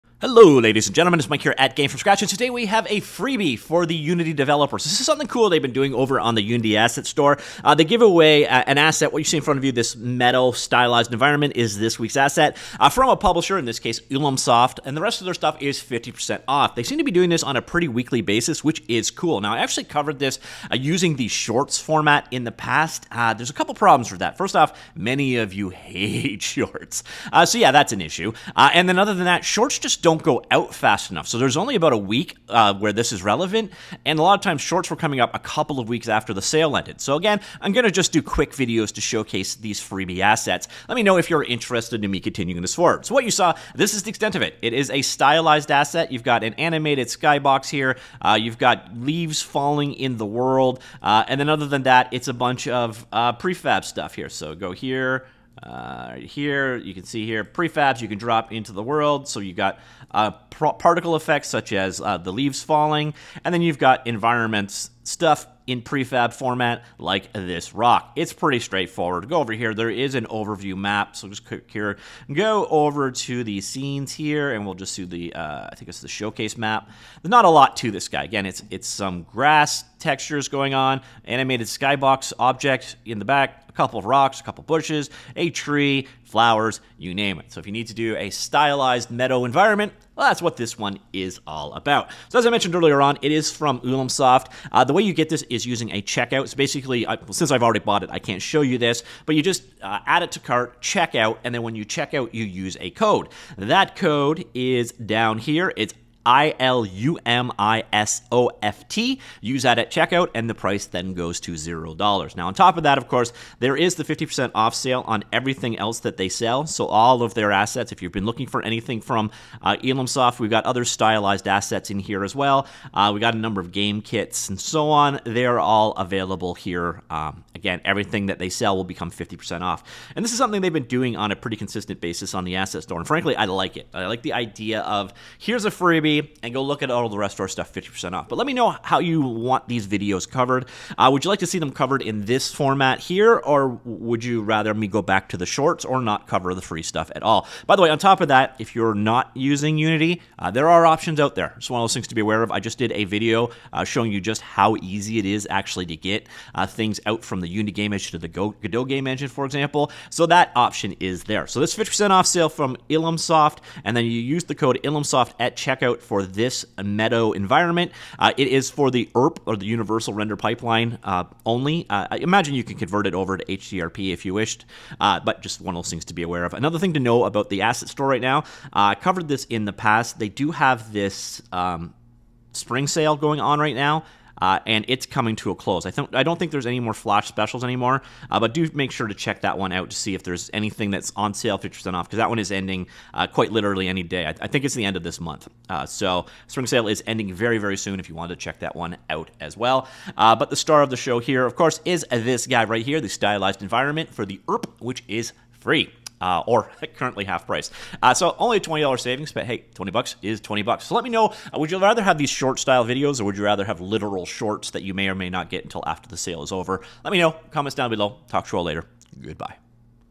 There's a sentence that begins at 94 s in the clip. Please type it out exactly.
Uh, the way you get this is using a checkout.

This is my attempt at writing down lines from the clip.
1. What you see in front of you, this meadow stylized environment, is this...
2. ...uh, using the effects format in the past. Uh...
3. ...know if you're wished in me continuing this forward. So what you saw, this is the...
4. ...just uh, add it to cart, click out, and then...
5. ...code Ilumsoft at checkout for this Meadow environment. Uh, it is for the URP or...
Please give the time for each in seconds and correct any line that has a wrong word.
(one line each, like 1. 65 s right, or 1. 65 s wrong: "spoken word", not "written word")
1. 9 s right
2. 20 s wrong: "shorts", not "effects"
3. 41 s wrong: "interested", not "wished"
4. 99 s wrong: "check", not "click"
5. 164 s right.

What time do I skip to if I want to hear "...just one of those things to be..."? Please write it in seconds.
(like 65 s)
175 s.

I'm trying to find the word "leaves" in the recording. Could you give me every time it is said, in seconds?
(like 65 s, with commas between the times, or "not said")
48 s, 62 s.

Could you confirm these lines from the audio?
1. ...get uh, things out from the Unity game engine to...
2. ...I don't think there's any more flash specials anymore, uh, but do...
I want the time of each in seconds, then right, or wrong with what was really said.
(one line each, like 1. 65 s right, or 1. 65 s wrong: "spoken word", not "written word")
1. 155 s right
2. 186 s right.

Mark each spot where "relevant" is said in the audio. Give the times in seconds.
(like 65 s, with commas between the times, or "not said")
33 s.